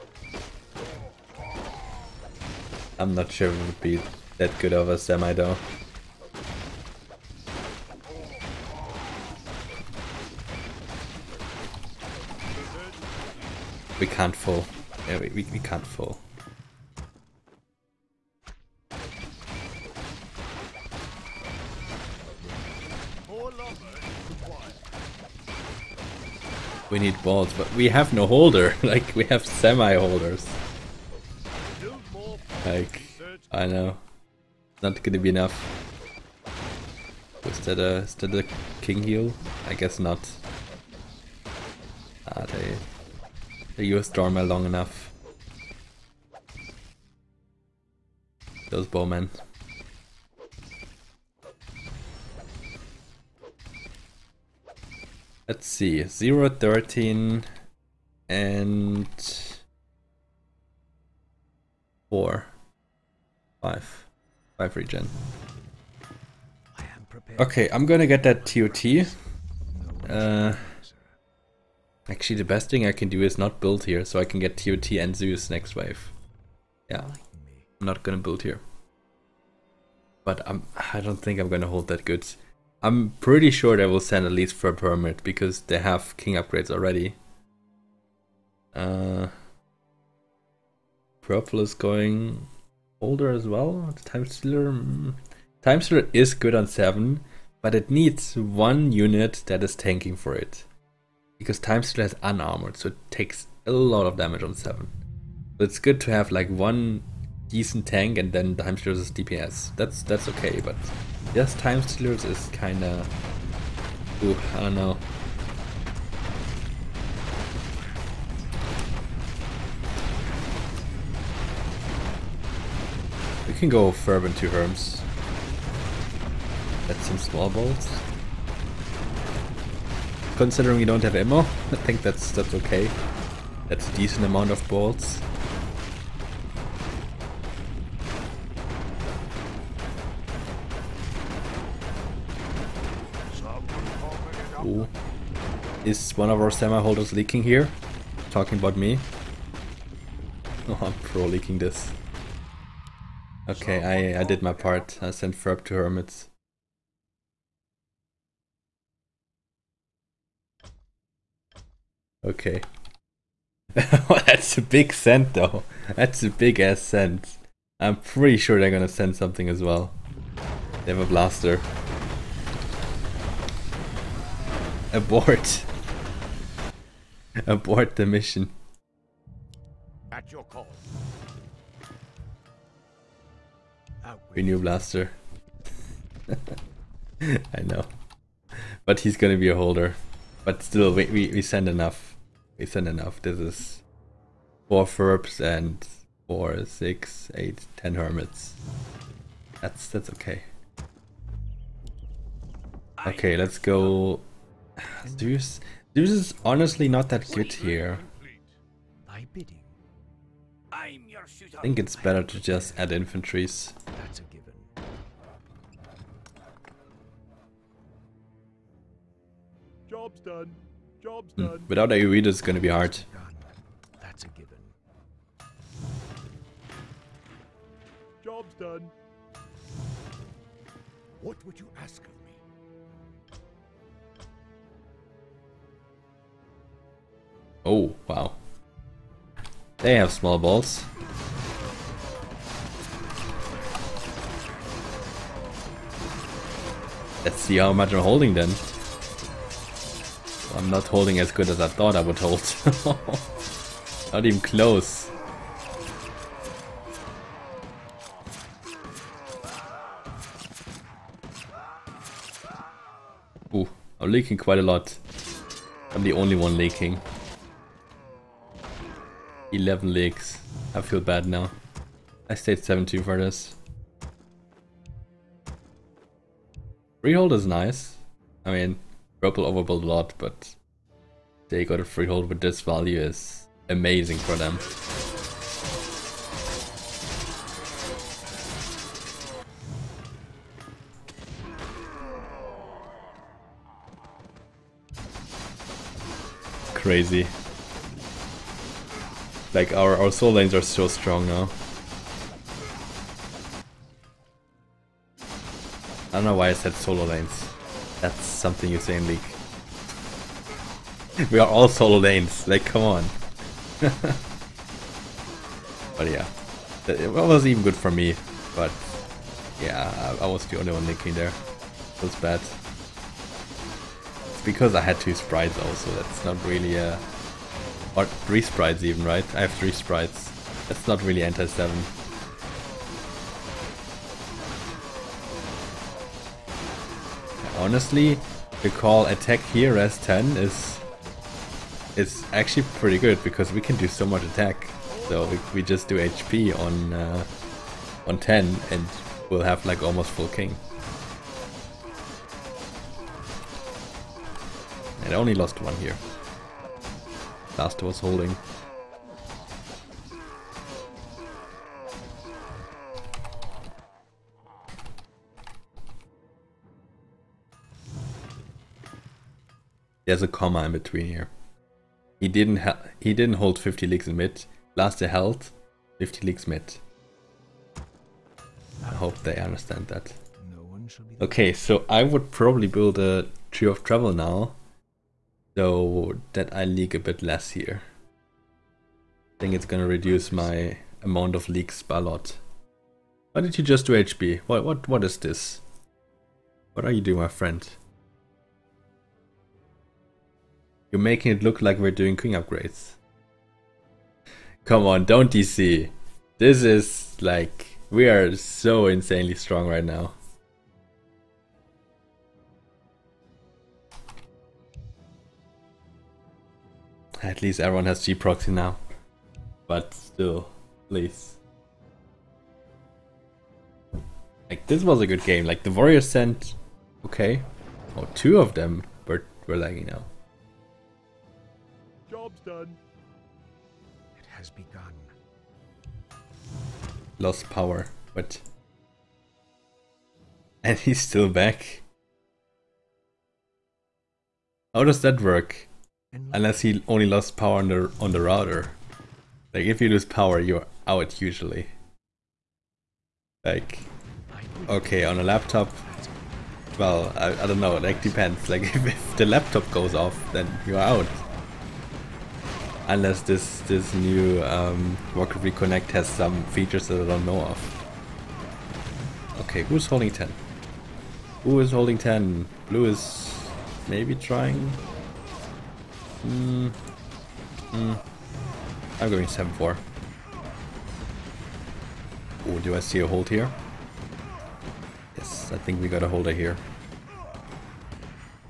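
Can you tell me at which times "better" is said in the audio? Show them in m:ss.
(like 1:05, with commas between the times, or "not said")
3:31.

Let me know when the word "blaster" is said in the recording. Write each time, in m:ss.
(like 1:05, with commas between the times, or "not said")
2:51, 3:04.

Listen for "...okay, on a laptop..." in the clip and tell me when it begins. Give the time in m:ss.
7:34.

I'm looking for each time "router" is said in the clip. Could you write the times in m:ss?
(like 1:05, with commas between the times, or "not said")
7:28.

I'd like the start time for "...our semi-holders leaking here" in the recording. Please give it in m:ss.
2:26.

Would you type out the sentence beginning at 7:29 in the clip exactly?
Like if you lose power you're out usually.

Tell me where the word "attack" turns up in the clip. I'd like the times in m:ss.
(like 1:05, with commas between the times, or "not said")
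5:39, 5:44.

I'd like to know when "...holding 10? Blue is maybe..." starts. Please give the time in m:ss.
7:51.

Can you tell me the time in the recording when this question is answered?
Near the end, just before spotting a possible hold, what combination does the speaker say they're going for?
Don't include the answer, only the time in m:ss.
7:59.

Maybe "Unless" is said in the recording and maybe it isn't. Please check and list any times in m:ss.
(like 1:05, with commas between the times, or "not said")
7:26, 7:42.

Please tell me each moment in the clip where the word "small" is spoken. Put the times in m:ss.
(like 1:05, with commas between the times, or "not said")
2:07, 4:00.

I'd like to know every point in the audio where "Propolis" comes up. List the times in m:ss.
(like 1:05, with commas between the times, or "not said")
1:31.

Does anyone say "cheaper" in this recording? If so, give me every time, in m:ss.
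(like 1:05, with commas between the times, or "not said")
not said.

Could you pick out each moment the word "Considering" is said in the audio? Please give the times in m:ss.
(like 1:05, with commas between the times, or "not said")
2:10.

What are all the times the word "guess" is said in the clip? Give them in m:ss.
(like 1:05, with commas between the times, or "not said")
0:39.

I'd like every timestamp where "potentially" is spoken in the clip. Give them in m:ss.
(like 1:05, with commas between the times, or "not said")
not said.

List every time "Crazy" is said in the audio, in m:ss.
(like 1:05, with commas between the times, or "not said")
4:56.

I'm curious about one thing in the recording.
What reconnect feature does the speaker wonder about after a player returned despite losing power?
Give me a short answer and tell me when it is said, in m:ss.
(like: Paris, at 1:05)
Rocket Reconnect, at 7:45.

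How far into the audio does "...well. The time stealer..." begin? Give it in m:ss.
1:33.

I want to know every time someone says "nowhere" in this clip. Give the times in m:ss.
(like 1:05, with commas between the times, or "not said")
not said.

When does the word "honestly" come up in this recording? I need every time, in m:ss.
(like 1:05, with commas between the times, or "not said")
3:26, 5:37.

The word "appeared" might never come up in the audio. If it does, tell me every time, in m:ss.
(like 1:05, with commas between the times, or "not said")
not said.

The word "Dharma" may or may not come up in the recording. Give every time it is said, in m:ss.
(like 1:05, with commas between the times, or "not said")
0:44.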